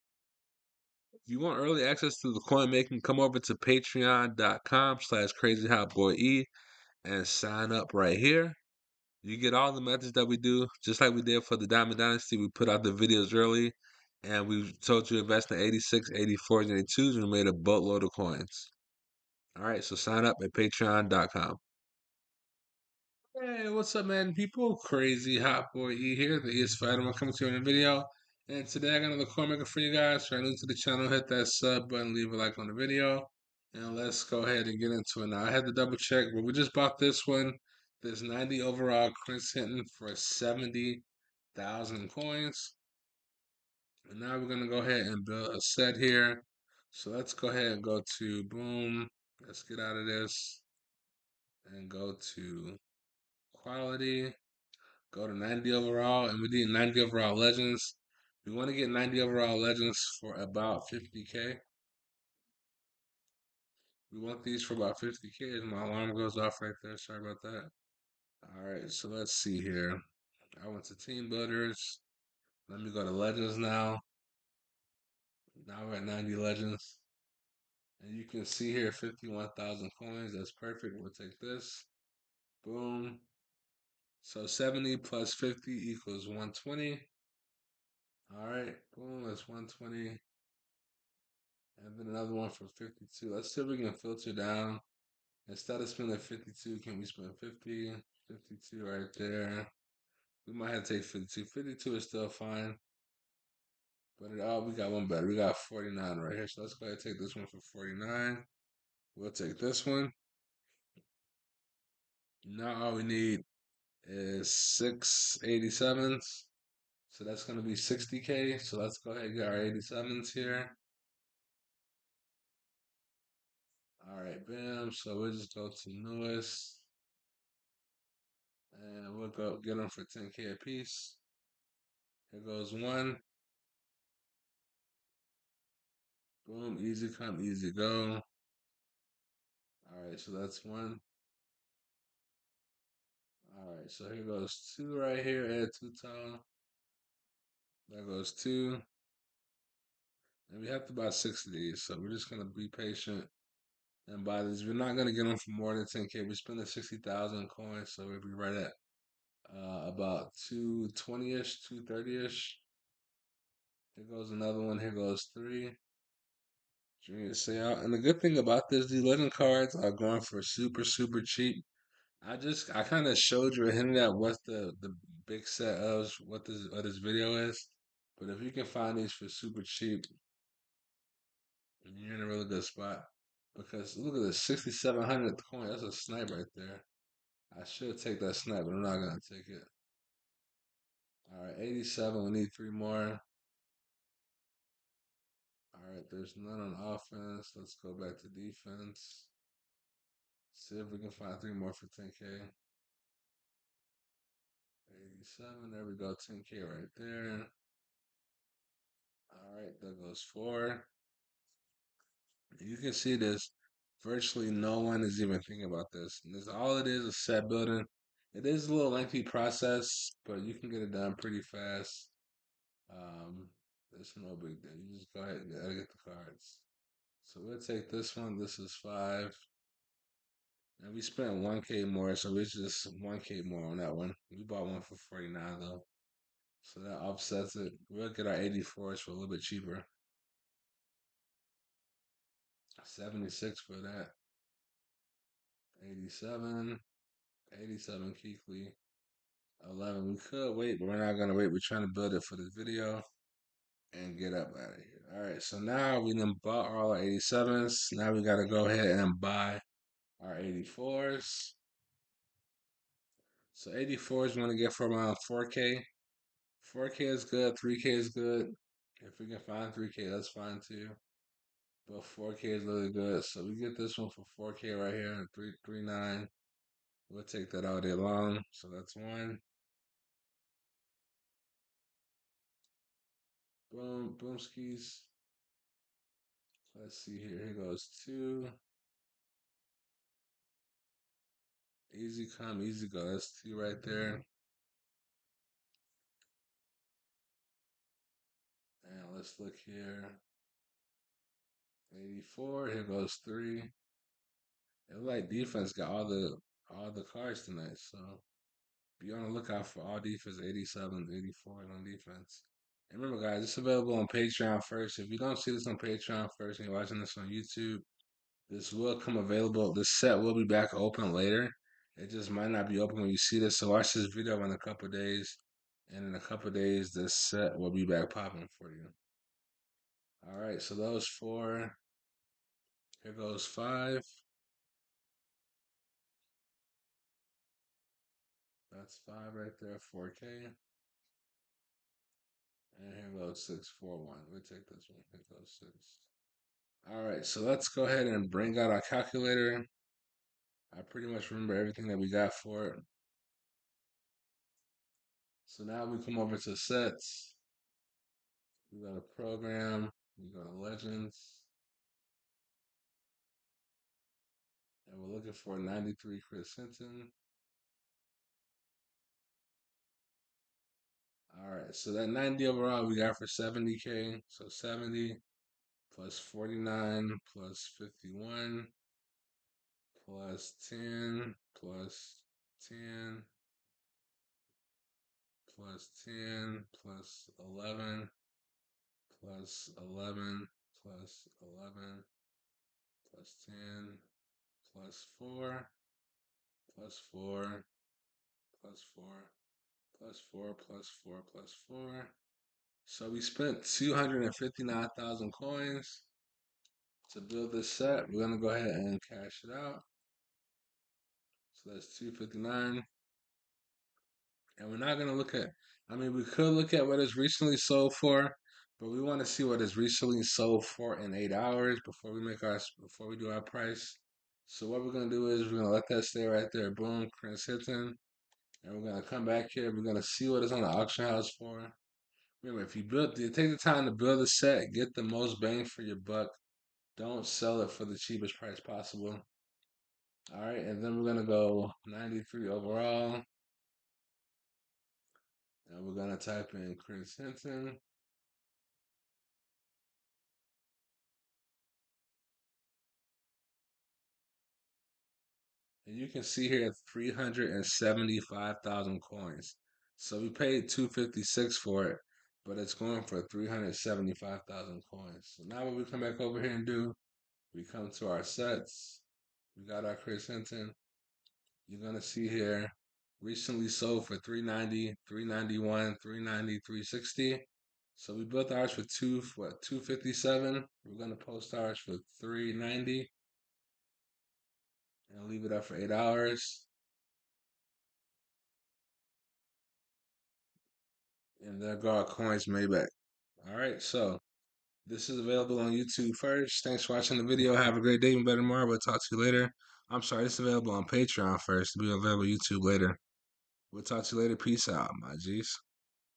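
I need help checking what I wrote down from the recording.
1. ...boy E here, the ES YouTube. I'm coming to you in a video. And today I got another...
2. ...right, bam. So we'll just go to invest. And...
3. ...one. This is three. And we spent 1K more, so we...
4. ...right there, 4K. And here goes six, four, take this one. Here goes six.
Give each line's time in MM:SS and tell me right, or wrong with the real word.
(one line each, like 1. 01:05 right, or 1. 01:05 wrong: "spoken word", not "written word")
1. 00:25 wrong: "Fighter", not "YouTube"
2. 02:04 wrong: "newest", not "invest"
3. 03:48 wrong: "five", not "three"
4. 05:39 right.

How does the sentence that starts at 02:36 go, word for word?
We spent the 60,000 coins, so we'll be right at uh, about 220 ish, 230 ish.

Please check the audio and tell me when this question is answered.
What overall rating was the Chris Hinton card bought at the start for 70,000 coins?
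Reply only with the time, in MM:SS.
00:38.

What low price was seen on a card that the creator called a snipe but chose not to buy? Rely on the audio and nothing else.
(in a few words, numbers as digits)
6,700.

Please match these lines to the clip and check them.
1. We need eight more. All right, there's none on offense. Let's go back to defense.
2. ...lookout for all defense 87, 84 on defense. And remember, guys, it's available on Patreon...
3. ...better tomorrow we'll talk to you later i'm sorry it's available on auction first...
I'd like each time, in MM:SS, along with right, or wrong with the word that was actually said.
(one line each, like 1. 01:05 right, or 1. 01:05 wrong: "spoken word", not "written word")
1. 03:12 wrong: "three", not "eight"
2. 05:09 right
3. 08:18 wrong: "patreon", not "auction".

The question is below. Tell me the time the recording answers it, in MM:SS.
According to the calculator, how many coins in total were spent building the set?
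06:43.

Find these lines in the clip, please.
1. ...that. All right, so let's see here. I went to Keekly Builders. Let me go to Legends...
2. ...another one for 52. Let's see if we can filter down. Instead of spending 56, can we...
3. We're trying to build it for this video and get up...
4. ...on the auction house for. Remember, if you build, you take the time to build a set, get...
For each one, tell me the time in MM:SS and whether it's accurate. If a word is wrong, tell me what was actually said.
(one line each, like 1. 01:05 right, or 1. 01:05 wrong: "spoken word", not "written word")
1. 01:07 wrong: "Team", not "Keekly"
2. 01:32 wrong: "52", not "56"
3. 04:11 right
4. 07:10 right.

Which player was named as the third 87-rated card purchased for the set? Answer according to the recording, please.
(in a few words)
Junior Seau.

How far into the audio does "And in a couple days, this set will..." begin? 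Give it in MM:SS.
05:25.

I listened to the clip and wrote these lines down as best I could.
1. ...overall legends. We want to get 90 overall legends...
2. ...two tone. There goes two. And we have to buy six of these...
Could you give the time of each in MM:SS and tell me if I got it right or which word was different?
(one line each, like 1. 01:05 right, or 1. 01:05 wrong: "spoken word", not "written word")
1. 00:57 right
2. 02:25 right.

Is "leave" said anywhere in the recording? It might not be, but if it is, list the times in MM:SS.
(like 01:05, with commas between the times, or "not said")
00:32, 08:05.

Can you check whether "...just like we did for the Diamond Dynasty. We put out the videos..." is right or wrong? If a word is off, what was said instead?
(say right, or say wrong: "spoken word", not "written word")
right.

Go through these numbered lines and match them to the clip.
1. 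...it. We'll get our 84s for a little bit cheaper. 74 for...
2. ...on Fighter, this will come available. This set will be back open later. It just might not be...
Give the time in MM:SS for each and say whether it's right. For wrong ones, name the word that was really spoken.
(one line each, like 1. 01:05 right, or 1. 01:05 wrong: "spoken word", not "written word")
1. 03:57 wrong: "76", not "74"
2. 05:17 wrong: "YouTube", not "Fighter".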